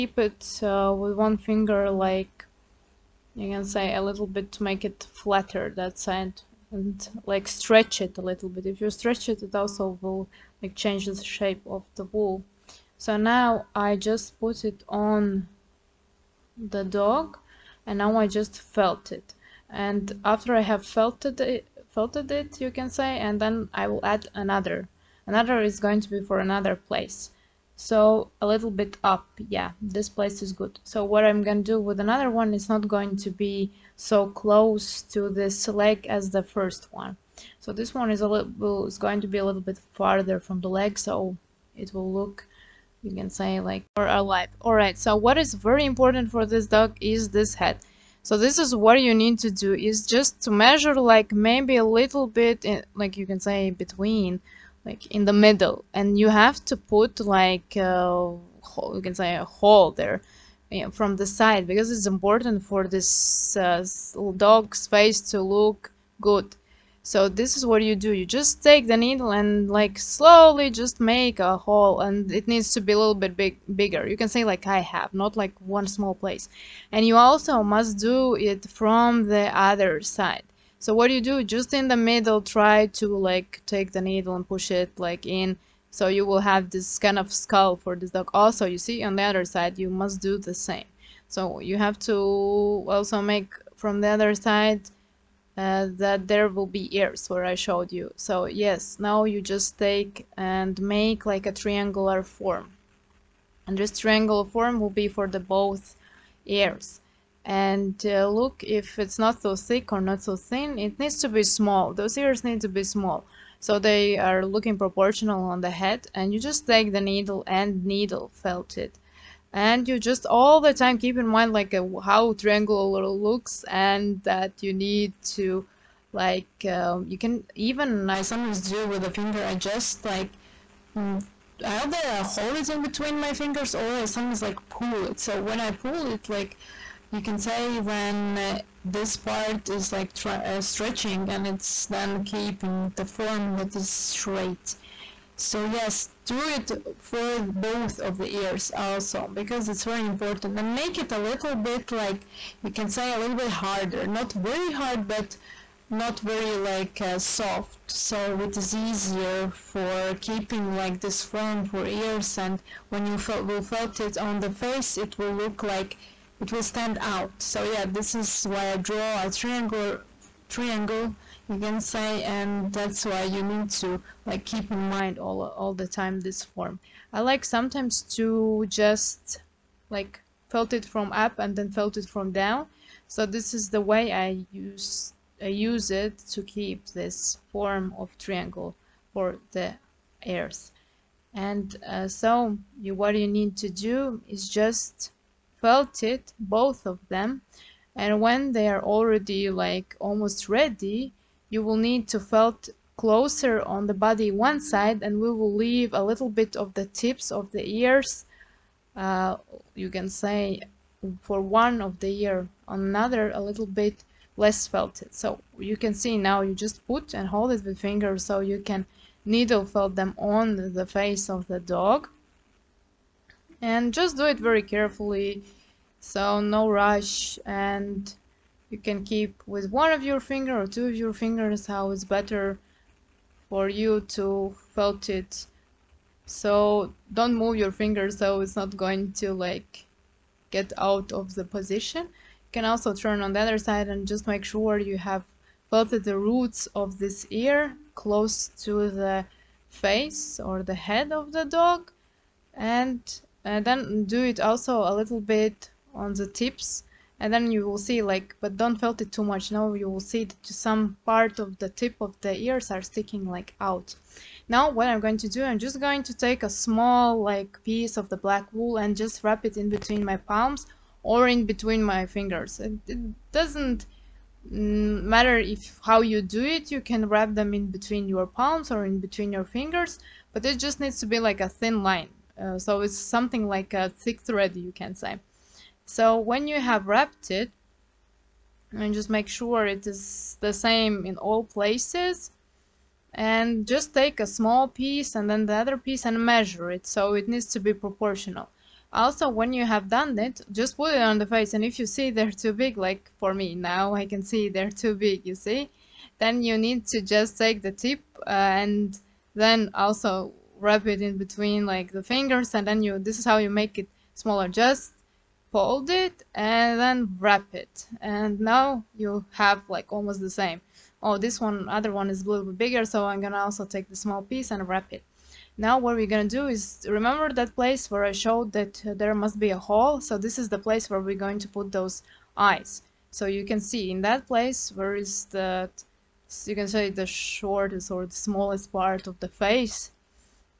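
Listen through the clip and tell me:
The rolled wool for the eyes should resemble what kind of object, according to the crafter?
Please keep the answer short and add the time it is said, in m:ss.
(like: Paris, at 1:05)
a thick thread, at 4:43.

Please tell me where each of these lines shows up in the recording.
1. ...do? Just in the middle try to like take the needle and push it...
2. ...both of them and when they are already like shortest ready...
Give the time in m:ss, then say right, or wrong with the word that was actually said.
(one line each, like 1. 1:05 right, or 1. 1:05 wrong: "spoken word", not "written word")
1. 1:21 right
2. 3:16 wrong: "almost", not "shortest".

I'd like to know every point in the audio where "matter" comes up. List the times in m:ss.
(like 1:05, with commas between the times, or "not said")
4:35.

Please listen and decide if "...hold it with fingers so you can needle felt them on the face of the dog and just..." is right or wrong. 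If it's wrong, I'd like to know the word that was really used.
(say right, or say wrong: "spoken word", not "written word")
right.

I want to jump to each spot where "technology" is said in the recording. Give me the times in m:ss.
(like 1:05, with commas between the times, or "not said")
not said.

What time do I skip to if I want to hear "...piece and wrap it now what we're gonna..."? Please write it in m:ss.
5:24.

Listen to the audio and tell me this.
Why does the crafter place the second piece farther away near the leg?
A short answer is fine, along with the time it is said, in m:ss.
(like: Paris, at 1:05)
more alive, at 0:43.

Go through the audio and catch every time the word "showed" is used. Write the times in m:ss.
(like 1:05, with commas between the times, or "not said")
1:37, 5:28.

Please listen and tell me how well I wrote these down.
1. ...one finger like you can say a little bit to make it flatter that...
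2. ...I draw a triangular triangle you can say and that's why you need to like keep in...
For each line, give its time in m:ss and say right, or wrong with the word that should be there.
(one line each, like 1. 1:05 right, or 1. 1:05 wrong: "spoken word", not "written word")
1. 0:01 right
2. 2:48 right.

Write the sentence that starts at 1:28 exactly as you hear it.
Also you see on the other side you must do the same.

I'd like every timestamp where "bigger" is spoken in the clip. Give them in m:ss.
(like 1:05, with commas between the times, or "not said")
1:13, 5:22.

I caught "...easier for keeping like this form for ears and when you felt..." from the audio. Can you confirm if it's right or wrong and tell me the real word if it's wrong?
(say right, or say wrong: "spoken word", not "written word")
right.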